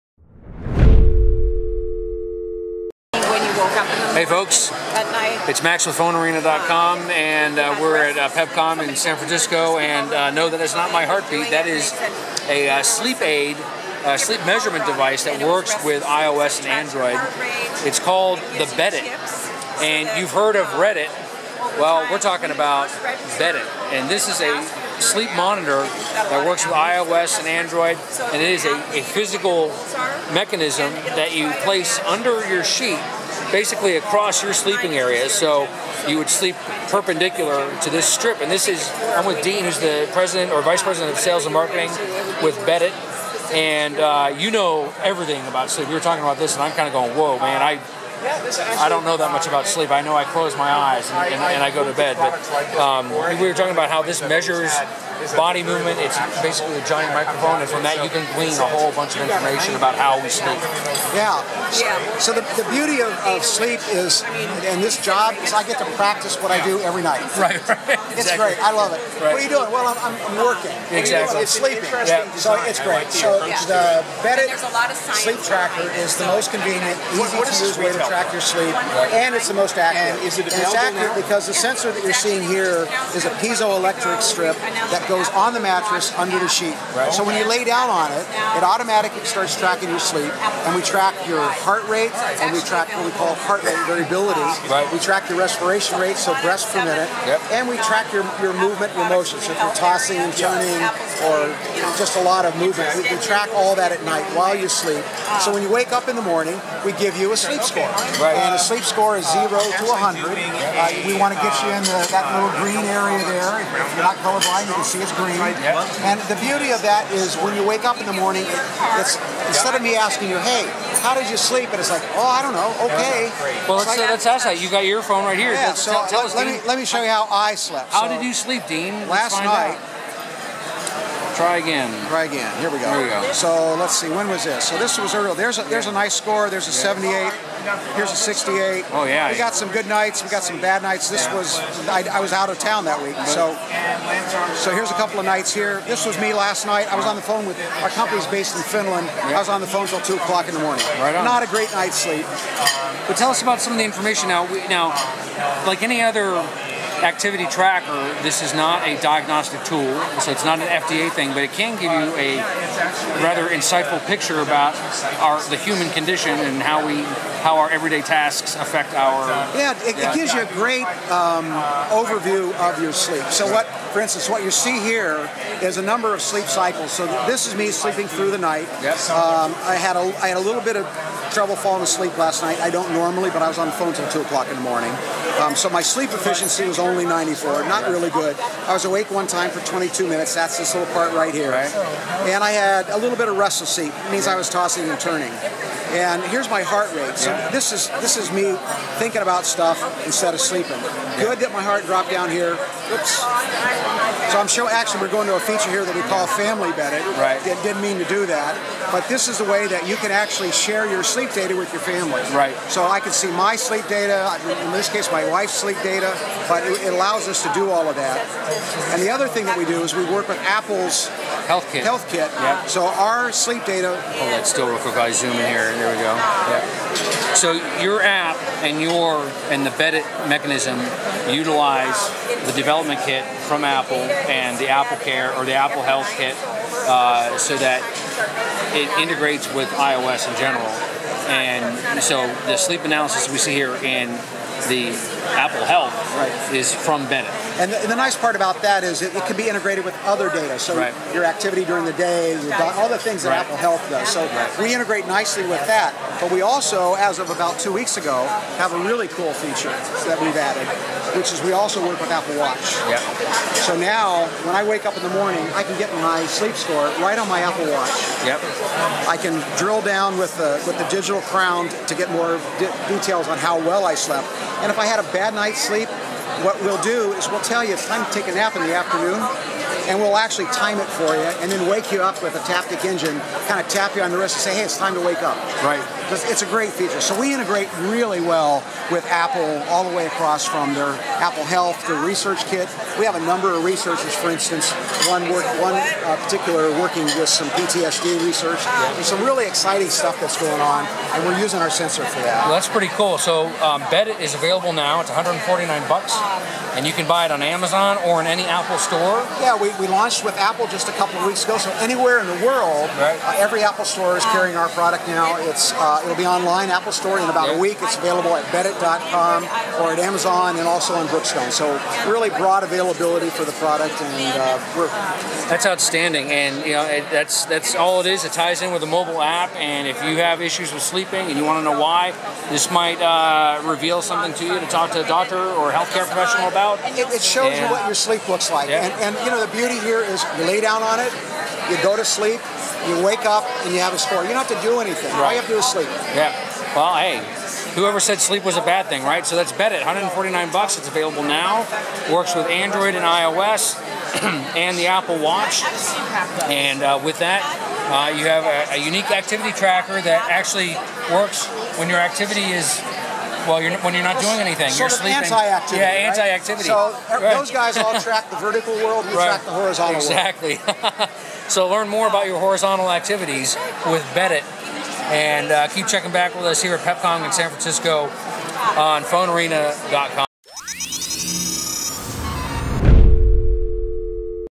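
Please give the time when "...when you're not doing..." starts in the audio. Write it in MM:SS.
06:03.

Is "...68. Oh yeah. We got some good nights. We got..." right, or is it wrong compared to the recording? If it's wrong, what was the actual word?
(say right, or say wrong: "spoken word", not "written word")
right.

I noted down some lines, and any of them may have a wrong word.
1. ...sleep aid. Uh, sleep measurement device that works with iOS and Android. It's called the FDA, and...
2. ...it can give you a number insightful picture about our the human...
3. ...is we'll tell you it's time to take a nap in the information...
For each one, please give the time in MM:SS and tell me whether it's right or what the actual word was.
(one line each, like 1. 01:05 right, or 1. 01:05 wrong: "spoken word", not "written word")
1. 00:12 wrong: "Beddit", not "FDA"
2. 02:41 wrong: "rather", not "number"
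3. 04:37 wrong: "afternoon", not "information".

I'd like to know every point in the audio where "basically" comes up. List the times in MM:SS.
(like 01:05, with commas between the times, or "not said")
00:33, 00:56.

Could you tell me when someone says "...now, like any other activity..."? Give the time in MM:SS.
02:34.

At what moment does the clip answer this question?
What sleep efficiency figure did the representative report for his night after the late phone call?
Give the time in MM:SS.
03:07.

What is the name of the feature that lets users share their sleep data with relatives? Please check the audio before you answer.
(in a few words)
Family Betting.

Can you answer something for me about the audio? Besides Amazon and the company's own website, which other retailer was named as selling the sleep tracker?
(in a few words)
Brookstone.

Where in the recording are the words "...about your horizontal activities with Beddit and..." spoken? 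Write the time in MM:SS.
06:12.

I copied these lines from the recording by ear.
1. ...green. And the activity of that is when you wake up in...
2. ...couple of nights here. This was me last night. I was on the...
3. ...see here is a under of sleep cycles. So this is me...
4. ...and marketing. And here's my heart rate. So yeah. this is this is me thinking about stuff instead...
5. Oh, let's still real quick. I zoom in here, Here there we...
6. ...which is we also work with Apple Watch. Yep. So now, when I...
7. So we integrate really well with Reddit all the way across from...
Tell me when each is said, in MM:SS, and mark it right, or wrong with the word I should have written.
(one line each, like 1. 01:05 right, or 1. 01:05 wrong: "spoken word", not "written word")
1. 01:55 wrong: "beauty", not "activity"
2. 02:24 right
3. 02:54 wrong: "number", not "under"
4. 03:14 wrong: "turning", not "marketing"
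5. 03:43 right
6. 04:21 right
7. 04:46 wrong: "Apple", not "Reddit".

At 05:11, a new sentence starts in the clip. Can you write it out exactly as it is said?
So anywhere in the world, right.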